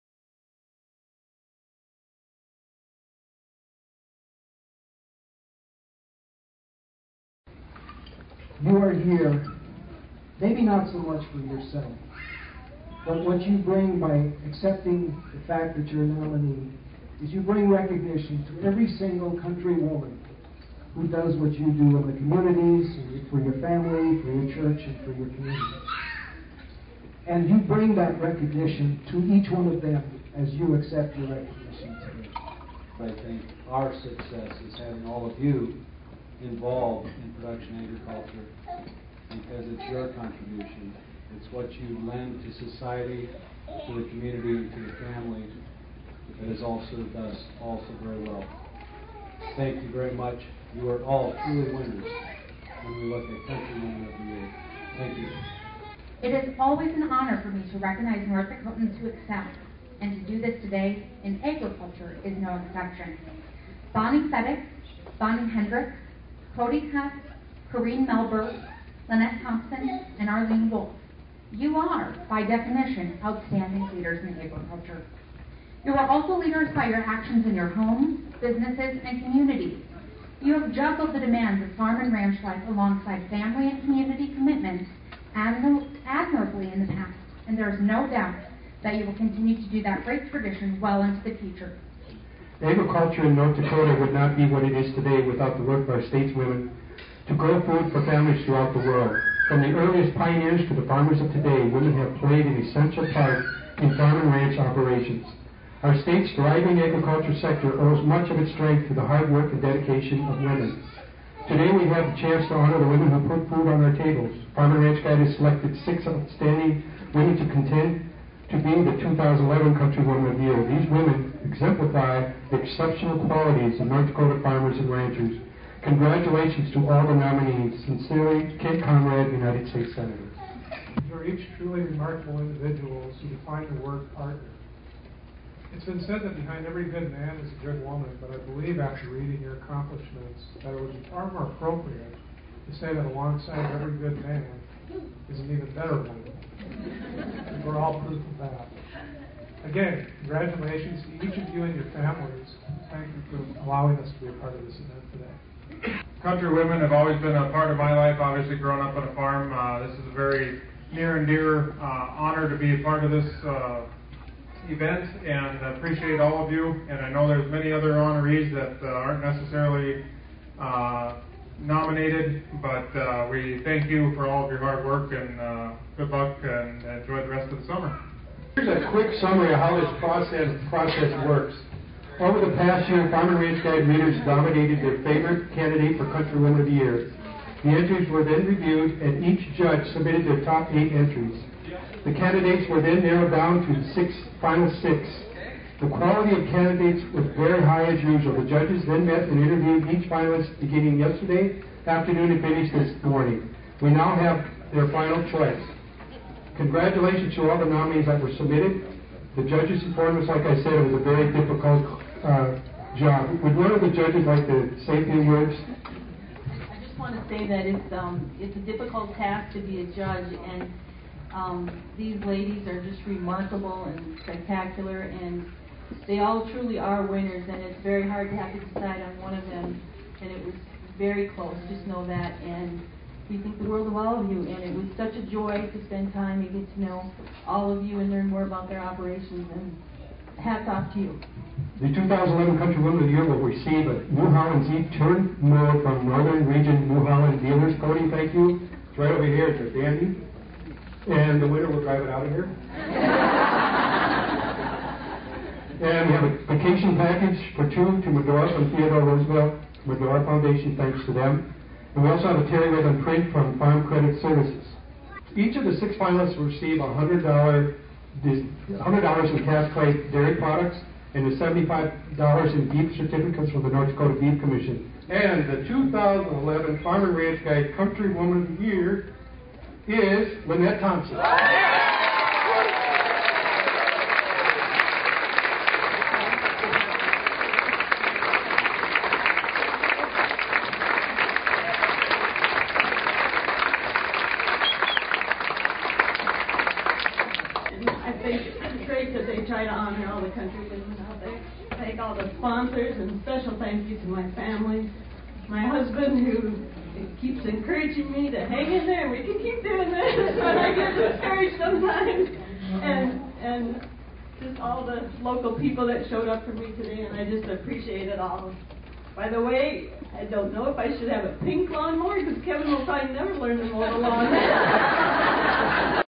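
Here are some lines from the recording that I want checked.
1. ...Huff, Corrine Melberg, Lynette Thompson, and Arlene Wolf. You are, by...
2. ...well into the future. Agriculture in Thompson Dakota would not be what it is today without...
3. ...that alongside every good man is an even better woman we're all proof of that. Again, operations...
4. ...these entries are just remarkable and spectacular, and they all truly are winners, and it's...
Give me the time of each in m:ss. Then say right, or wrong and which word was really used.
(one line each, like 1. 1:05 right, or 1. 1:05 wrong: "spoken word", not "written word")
1. 1:06 right
2. 1:30 wrong: "North", not "Thompson"
3. 2:22 wrong: "congratulations", not "operations"
4. 3:41 wrong: "ladies", not "entries".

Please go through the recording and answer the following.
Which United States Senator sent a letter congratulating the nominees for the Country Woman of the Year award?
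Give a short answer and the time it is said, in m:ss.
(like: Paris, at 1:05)
Kent Conrad, at 2:08.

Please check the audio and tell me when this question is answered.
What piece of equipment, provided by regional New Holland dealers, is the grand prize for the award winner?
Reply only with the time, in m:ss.
4:04.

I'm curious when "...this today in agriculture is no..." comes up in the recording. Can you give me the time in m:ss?
1:00.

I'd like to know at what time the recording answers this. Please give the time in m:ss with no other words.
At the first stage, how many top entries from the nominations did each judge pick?
3:10.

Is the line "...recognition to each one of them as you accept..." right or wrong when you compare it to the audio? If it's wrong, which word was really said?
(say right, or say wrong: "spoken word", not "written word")
right.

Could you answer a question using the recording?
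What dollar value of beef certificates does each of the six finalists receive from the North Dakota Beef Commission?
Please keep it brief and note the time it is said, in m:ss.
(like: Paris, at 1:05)
$75, at 4:31.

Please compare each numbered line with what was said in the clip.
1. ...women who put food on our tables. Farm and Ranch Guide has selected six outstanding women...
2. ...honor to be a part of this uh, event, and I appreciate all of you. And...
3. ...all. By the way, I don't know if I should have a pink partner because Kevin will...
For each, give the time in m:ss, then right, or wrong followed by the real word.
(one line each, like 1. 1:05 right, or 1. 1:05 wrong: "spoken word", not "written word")
1. 1:52 right
2. 2:42 right
3. 5:18 wrong: "lawnmower", not "partner".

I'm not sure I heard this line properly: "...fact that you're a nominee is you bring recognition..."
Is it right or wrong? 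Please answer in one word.
right.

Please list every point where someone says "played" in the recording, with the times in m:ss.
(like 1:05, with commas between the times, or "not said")
1:42.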